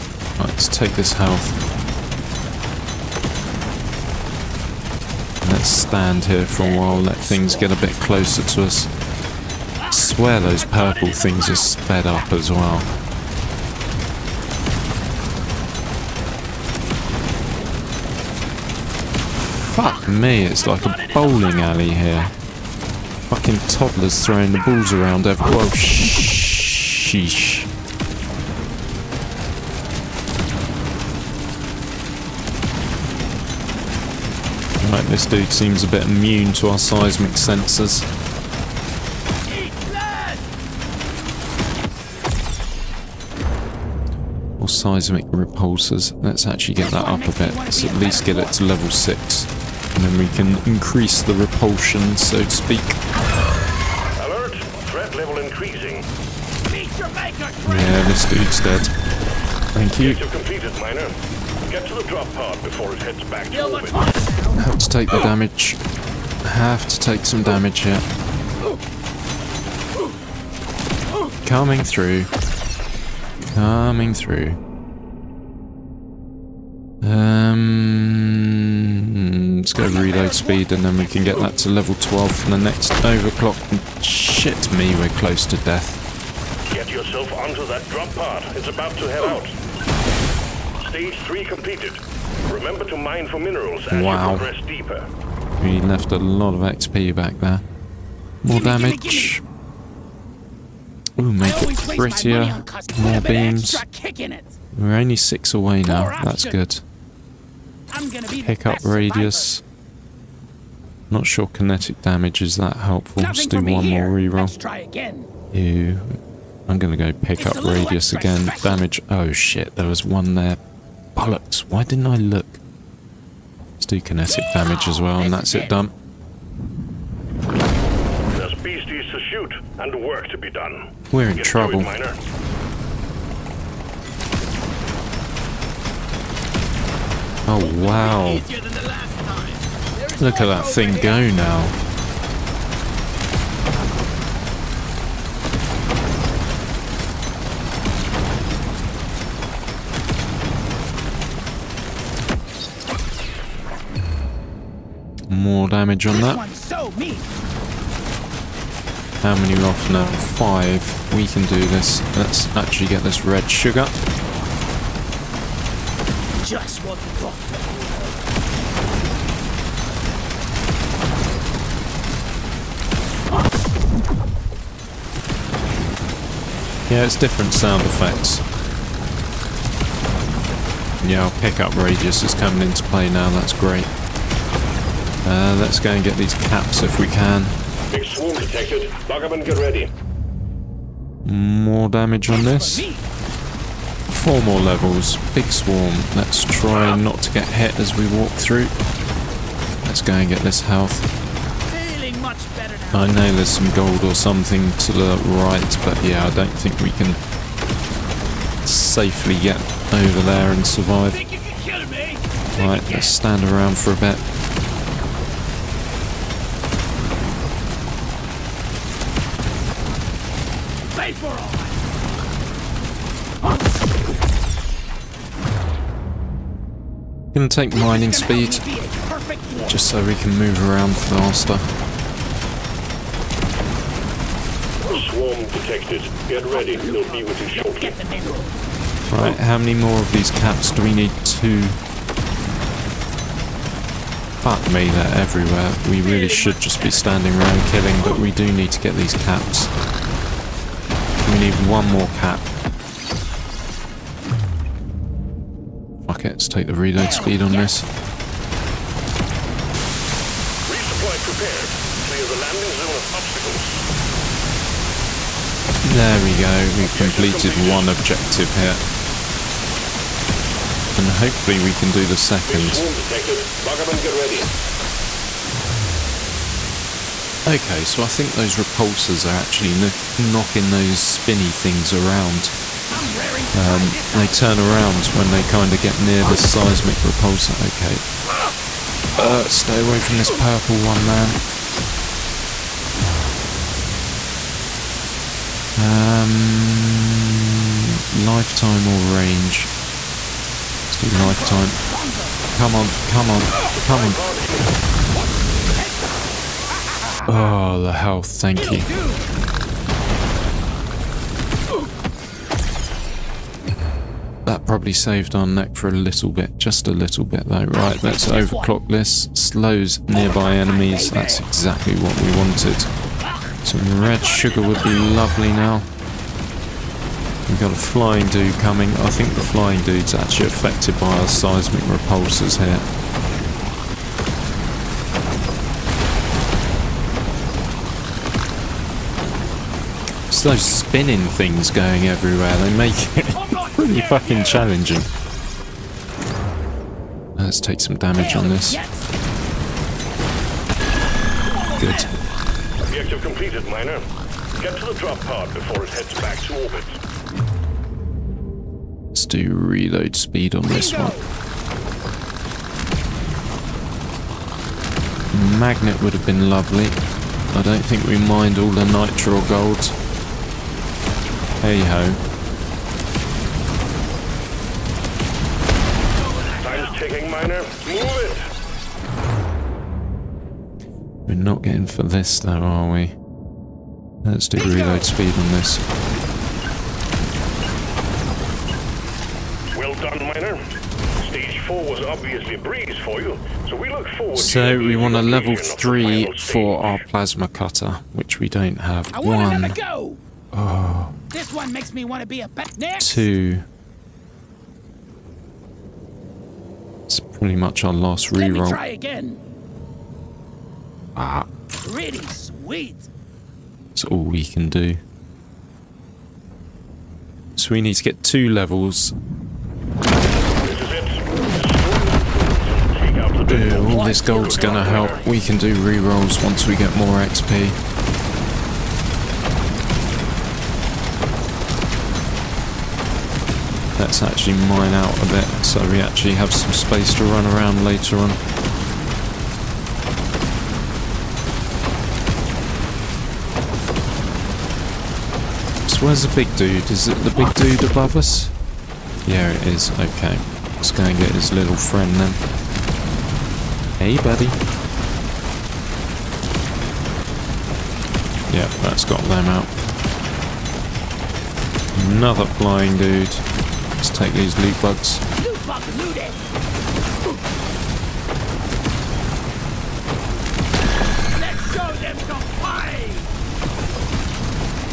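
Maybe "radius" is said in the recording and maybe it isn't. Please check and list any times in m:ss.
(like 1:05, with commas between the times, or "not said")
1:48, 1:57, 3:01.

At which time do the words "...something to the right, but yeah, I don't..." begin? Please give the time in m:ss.
3:24.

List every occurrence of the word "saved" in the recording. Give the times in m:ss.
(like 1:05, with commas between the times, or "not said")
5:14.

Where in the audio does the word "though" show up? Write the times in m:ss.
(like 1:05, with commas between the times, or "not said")
5:17, 6:22.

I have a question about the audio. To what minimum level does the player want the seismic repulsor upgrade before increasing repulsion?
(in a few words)
6.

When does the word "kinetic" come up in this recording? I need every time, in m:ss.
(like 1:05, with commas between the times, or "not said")
1:51, 2:04.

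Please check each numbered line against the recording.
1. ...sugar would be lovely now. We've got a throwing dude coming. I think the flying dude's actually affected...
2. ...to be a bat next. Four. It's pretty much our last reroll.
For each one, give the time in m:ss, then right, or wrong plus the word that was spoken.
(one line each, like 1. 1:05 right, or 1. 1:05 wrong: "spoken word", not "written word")
1. 5:24 wrong: "flying", not "throwing"
2. 6:42 wrong: "Two", not "Four".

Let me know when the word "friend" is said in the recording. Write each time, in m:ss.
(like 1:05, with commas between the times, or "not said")
7:31.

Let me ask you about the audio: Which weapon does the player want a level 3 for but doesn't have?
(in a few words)
plasma cutter.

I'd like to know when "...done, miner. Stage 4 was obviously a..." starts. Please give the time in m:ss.
6:29.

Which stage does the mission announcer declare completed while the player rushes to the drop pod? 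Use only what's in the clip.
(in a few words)
Stage 3.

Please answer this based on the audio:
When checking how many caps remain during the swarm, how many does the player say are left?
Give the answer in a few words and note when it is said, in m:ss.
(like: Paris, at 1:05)
Five, at 2:40.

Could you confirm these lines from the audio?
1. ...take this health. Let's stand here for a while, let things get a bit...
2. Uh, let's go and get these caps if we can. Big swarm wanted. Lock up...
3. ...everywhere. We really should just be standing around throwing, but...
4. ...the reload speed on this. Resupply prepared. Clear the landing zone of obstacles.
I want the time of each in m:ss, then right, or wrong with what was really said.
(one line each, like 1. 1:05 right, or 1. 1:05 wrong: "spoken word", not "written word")
1. 0:00 right
2. 3:05 wrong: "detected", not "wanted"
3. 4:05 wrong: "killing", not "throwing"
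4. 4:16 right.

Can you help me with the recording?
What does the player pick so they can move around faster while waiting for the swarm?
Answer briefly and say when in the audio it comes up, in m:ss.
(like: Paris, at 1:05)
mining speed, at 3:47.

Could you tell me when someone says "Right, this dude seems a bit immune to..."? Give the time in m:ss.
0:34.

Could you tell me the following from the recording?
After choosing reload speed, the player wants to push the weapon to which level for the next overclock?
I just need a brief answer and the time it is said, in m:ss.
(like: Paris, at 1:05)
12, at 1:21.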